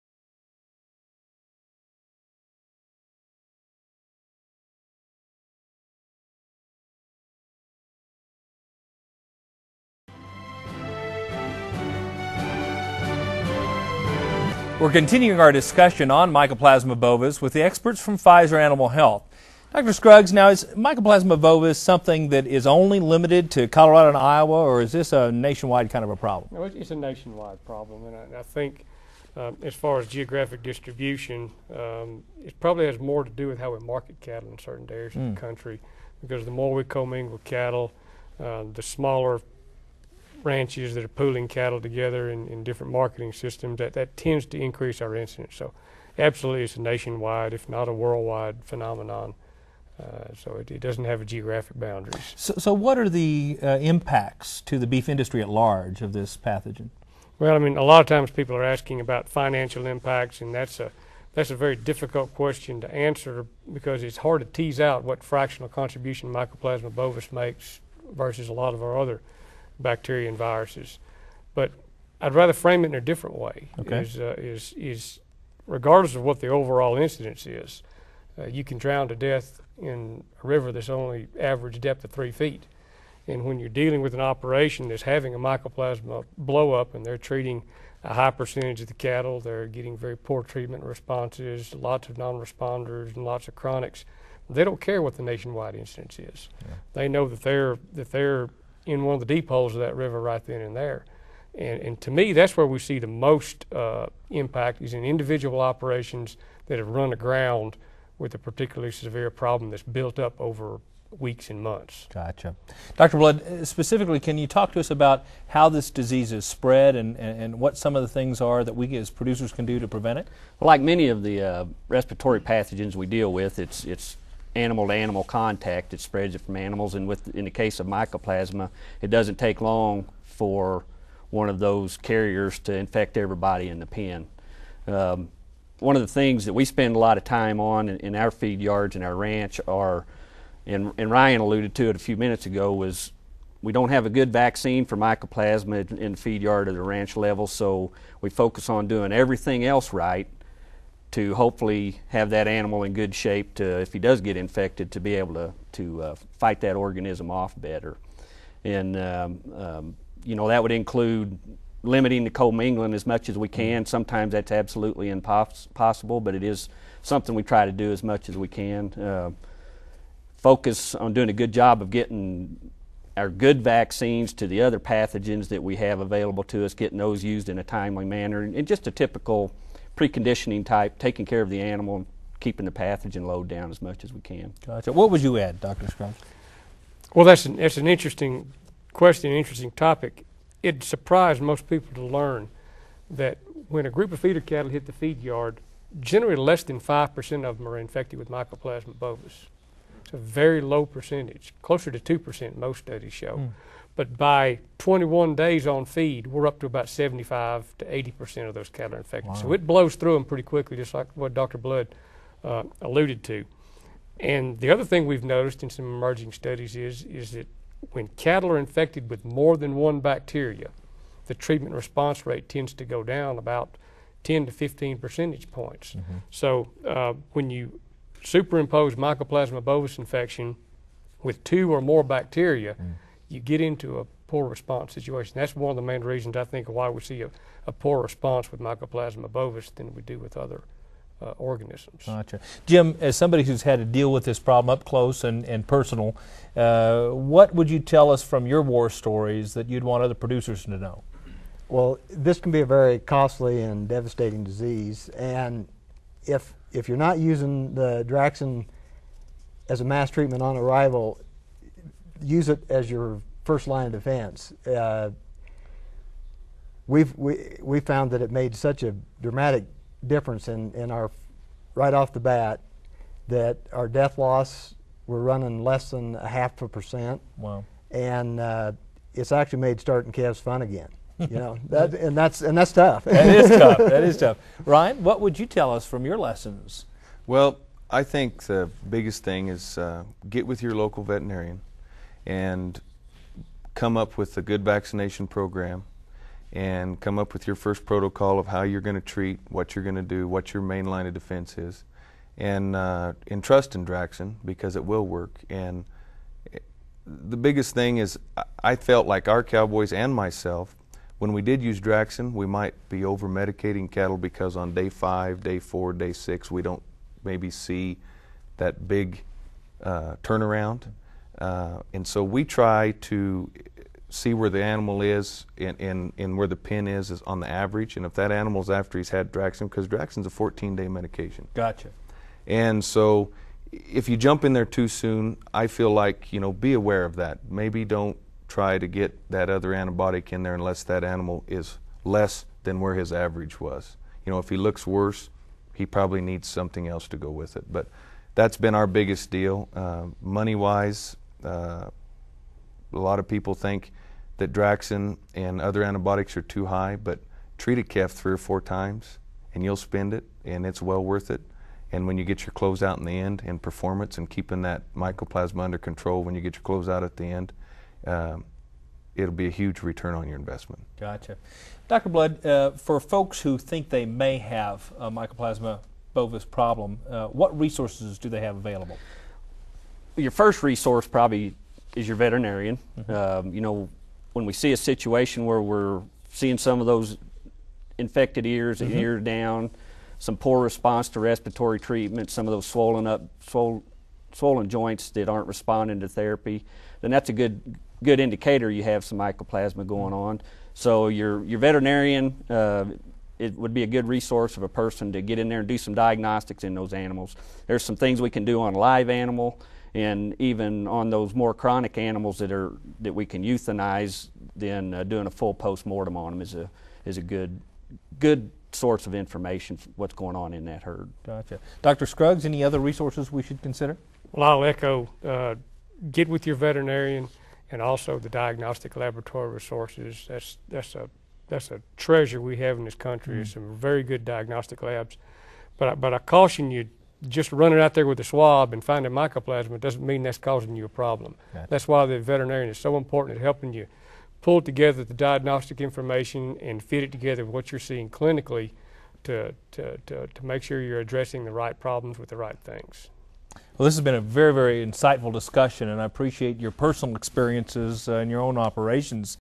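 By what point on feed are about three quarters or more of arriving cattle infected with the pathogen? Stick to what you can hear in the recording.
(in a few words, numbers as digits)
21 days.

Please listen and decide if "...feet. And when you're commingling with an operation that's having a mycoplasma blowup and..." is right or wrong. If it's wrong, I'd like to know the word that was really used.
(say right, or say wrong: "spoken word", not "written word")
wrong: "dealing", not "commingling".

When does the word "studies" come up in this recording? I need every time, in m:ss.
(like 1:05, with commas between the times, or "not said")
3:22, 3:36.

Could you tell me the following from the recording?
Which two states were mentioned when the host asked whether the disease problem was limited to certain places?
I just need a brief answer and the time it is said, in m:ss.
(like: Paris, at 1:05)
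Colorado and Iowa, at 0:23.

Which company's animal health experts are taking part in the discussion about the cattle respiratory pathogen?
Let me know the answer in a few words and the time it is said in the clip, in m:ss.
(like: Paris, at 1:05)
Pfizer, at 0:18.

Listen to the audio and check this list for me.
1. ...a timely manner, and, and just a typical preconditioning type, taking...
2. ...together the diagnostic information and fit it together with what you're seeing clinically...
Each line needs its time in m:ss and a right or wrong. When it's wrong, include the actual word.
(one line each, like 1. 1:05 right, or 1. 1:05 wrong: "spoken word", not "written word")
1. 2:57 right
2. 7:24 right.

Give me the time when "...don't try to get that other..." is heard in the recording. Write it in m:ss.
5:37.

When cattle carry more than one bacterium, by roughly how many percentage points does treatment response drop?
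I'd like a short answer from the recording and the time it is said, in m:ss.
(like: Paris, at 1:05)
10 to 15, at 3:44.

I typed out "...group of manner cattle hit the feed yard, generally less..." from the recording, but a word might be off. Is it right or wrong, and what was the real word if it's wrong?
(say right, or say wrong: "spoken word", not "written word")
wrong: "feeder", not "manner".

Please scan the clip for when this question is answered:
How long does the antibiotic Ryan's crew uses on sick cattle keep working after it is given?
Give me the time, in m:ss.
5:30.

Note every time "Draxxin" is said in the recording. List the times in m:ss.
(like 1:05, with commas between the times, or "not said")
4:18, 5:03, 5:11, 5:29, 5:54.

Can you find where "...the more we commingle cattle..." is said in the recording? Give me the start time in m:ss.
0:36.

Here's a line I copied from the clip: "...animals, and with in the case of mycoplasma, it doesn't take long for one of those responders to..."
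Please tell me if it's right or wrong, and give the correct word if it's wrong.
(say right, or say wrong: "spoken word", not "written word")
wrong: "carriers", not "responders".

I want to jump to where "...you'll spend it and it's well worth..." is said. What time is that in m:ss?
5:59.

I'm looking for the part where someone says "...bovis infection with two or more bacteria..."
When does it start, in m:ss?
3:49.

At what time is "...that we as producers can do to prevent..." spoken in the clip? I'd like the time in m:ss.
1:58.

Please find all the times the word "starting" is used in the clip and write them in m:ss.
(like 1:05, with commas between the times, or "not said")
4:39.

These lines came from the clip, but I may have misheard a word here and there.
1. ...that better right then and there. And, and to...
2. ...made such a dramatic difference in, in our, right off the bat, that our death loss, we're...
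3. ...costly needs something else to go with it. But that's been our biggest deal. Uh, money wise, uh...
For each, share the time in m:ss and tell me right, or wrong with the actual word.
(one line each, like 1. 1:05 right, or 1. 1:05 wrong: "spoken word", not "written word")
1. 1:39 wrong: "river", not "better"
2. 4:28 right
3. 5:45 wrong: "probably", not "costly".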